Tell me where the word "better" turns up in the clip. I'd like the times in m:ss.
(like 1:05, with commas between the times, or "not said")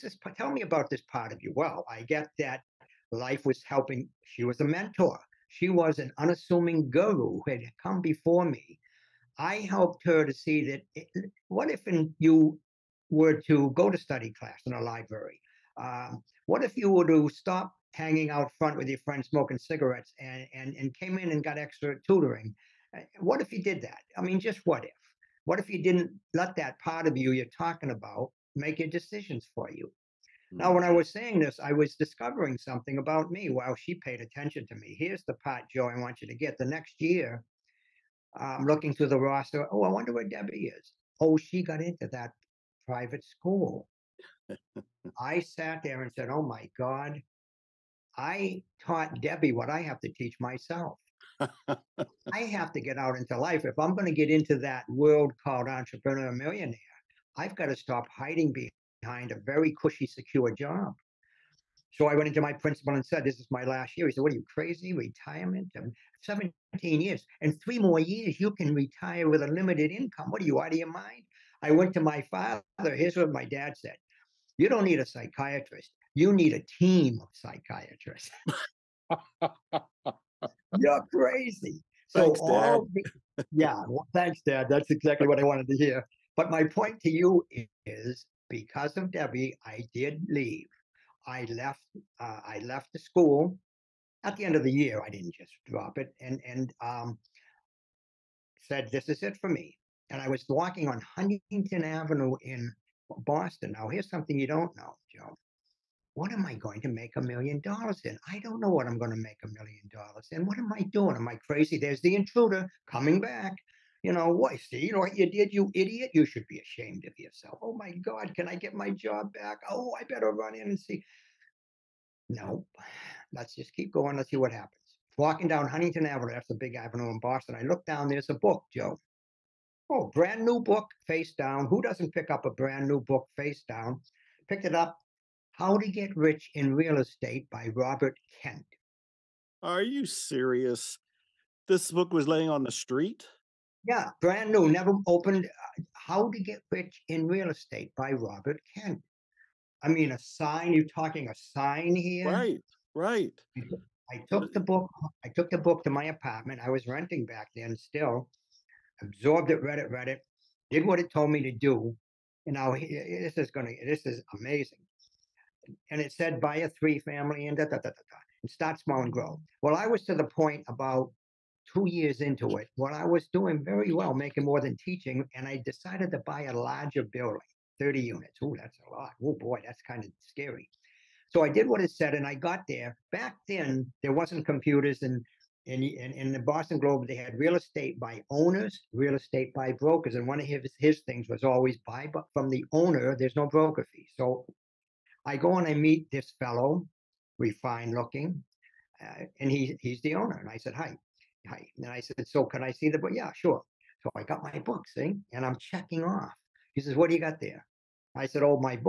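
2:00.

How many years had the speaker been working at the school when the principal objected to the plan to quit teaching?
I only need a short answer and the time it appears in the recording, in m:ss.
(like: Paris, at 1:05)
17 years, at 1:06.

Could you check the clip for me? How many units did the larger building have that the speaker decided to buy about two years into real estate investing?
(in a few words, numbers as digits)
30.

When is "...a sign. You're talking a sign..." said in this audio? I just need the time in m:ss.
2:30.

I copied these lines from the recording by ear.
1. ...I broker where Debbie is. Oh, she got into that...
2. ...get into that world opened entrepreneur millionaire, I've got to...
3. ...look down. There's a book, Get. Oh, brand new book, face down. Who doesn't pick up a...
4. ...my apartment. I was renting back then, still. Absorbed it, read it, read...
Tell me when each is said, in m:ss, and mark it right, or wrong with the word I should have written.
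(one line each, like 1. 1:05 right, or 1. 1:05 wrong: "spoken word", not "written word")
1. 0:39 wrong: "wonder", not "broker"
2. 0:54 wrong: "called", not "opened"
3. 2:07 wrong: "Joe", not "Get"
4. 2:35 right.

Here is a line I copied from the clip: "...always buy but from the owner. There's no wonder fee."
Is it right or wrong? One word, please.
wrong.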